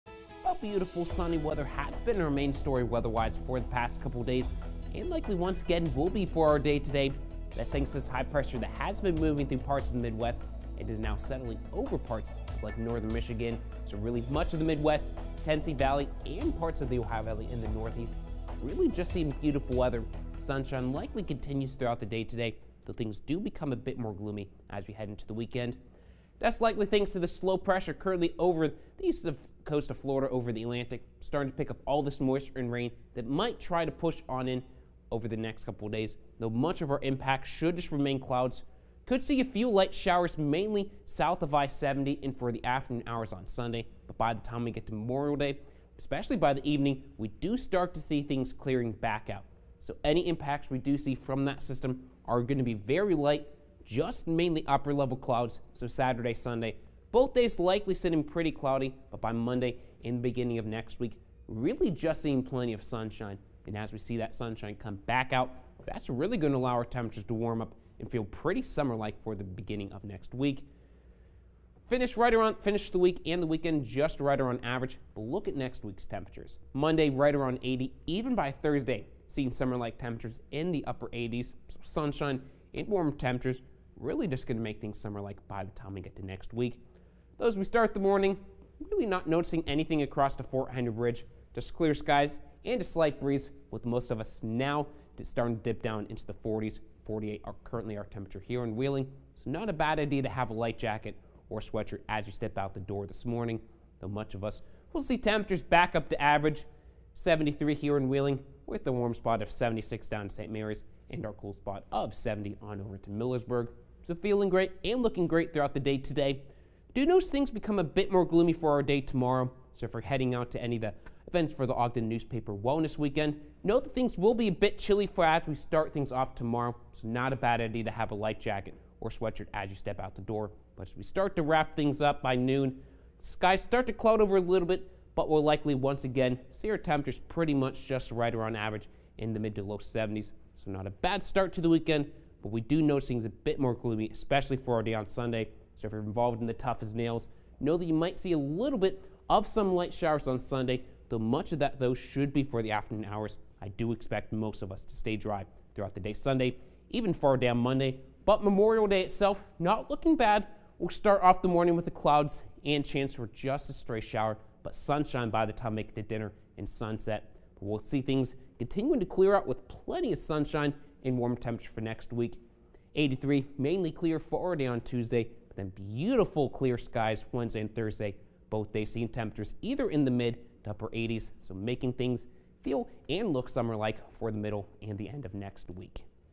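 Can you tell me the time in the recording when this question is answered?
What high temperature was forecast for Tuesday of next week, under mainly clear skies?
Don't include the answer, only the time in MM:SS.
02:52.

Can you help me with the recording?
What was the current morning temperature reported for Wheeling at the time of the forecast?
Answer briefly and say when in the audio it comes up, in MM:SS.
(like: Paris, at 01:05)
48, at 01:37.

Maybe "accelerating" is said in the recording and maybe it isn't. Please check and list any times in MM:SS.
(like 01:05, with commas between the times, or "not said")
not said.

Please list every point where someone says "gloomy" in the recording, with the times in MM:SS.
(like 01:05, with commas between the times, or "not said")
00:24, 01:58, 02:23.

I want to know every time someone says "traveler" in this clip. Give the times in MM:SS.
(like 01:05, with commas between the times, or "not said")
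not said.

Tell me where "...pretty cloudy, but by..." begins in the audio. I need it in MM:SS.
00:58.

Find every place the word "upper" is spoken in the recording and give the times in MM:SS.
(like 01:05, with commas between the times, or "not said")
00:54, 01:20, 03:00.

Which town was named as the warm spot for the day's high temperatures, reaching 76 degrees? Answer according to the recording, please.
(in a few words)
St. Mary's.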